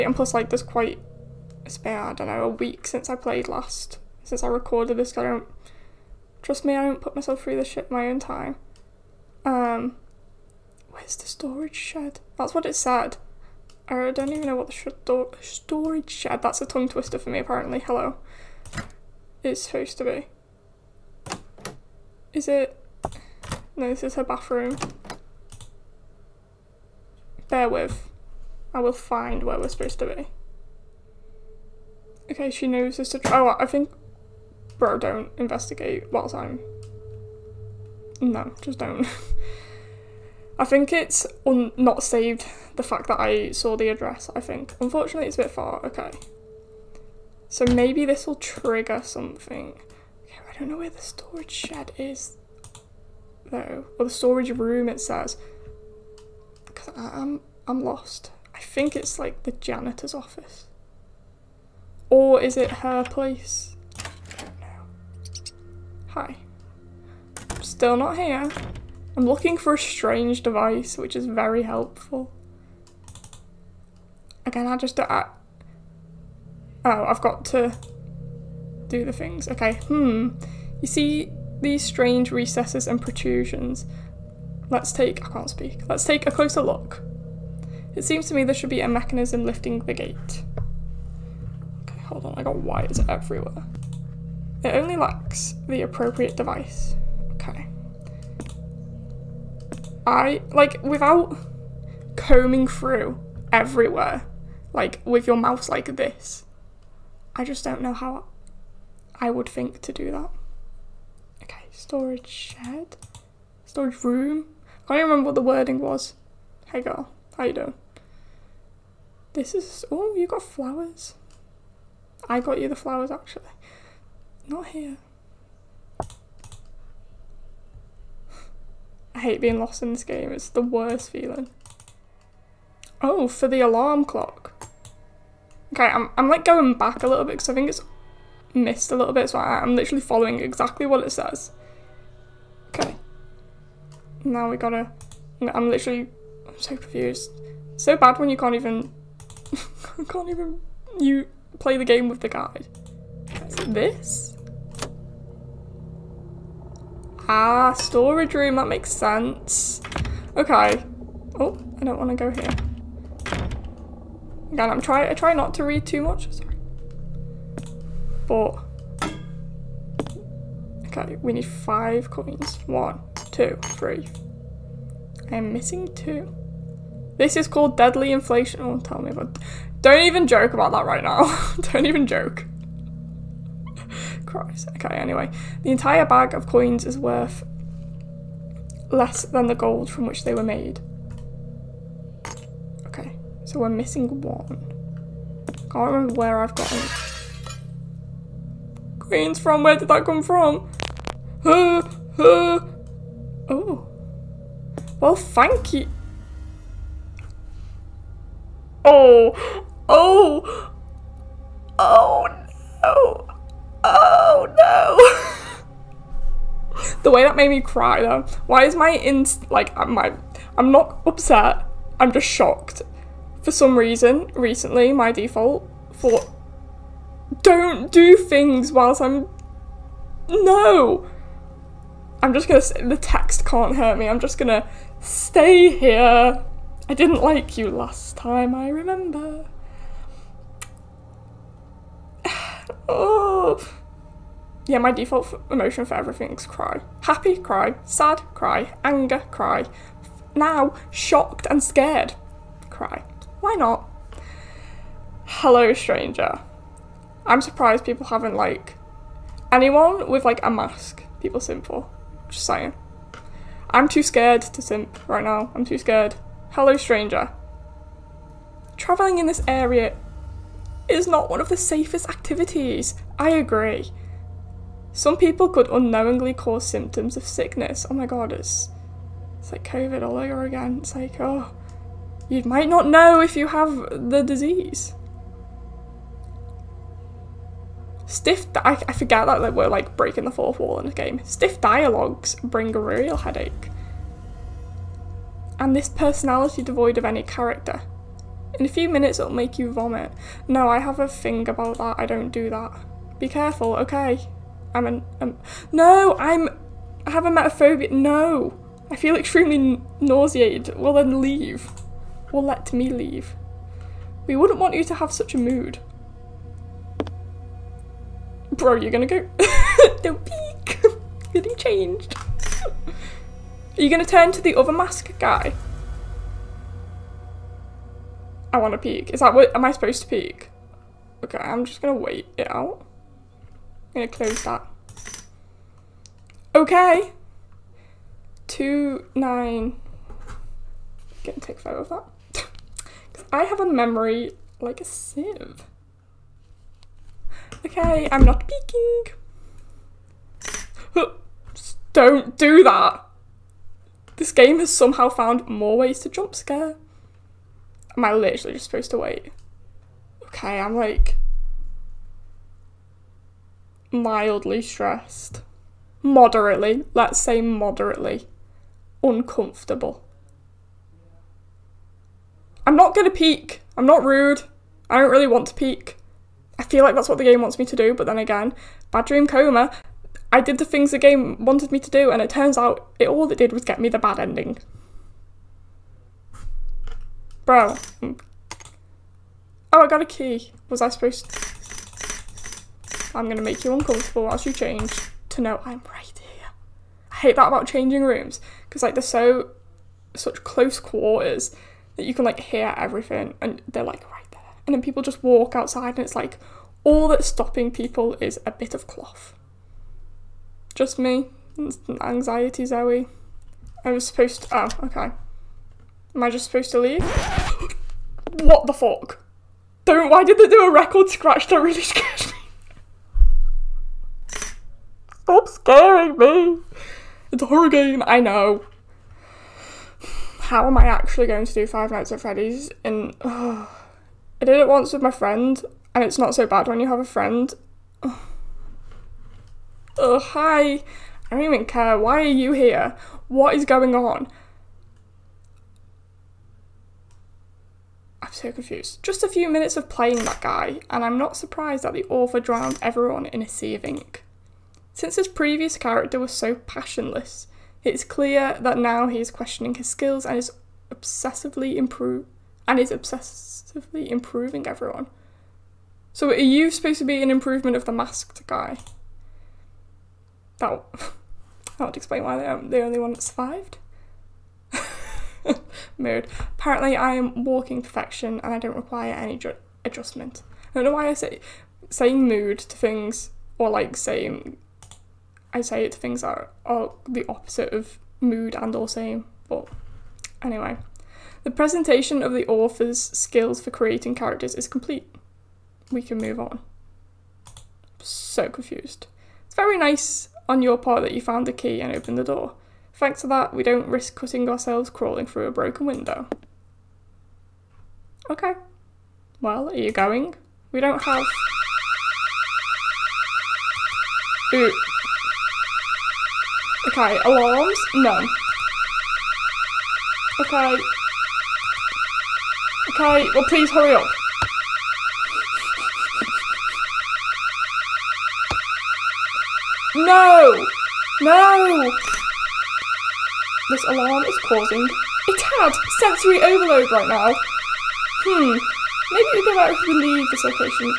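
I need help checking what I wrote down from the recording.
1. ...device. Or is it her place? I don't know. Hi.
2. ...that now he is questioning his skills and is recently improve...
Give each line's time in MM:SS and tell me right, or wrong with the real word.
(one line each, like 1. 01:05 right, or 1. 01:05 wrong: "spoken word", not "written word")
1. 01:00 wrong: "office", not "device"
2. 07:38 wrong: "obsessively", not "recently".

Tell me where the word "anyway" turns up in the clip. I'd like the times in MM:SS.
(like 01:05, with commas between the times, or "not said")
03:04, 08:10.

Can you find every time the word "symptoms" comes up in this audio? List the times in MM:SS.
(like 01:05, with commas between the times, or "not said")
04:36.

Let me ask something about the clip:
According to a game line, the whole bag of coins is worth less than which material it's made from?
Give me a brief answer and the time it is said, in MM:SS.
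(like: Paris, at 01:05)
Gold, at 03:09.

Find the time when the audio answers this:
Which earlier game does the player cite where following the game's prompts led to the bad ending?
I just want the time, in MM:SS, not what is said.
06:18.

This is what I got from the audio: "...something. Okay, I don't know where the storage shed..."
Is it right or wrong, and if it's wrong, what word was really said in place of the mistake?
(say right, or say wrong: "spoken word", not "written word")
right.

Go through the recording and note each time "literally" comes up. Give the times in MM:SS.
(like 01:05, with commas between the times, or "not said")
02:19, 02:25, 05:58.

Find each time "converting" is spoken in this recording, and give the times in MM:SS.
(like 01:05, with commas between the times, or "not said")
not said.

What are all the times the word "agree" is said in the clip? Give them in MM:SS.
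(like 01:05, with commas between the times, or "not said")
04:33.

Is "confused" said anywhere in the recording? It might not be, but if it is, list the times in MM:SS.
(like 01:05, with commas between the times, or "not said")
02:26, 07:28, 08:18.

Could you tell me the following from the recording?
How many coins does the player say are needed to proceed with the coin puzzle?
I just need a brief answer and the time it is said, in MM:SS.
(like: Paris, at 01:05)
5, at 02:51.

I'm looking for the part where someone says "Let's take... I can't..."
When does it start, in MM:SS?
01:24.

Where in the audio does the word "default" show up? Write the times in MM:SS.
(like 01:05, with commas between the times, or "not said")
03:45, 04:04.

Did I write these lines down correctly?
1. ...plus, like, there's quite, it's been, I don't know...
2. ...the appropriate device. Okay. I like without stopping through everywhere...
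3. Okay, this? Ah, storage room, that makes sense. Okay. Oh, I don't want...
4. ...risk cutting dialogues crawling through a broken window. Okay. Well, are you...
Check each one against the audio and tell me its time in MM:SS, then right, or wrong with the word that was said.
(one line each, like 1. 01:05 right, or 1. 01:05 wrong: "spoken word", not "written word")
1. 00:00 right
2. 01:35 wrong: "combing", not "stopping"
3. 02:33 right
4. 08:23 wrong: "ourselves", not "dialogues".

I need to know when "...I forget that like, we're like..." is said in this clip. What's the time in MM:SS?
04:48.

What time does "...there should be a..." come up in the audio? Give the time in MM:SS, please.
01:28.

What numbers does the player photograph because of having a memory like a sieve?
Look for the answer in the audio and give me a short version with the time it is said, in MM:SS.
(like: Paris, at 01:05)
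2, 9, at 05:38.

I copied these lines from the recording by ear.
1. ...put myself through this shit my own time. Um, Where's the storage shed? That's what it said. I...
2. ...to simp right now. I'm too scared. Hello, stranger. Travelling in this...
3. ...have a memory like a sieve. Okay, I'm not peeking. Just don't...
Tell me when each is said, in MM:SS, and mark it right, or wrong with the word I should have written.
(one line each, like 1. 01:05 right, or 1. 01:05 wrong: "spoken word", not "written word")
1. 00:07 right
2. 04:24 right
3. 05:43 right.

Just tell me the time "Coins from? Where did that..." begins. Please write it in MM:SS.
03:18.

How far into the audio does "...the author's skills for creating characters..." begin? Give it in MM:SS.
08:12.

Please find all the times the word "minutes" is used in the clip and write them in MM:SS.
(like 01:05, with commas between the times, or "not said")
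04:58, 07:29.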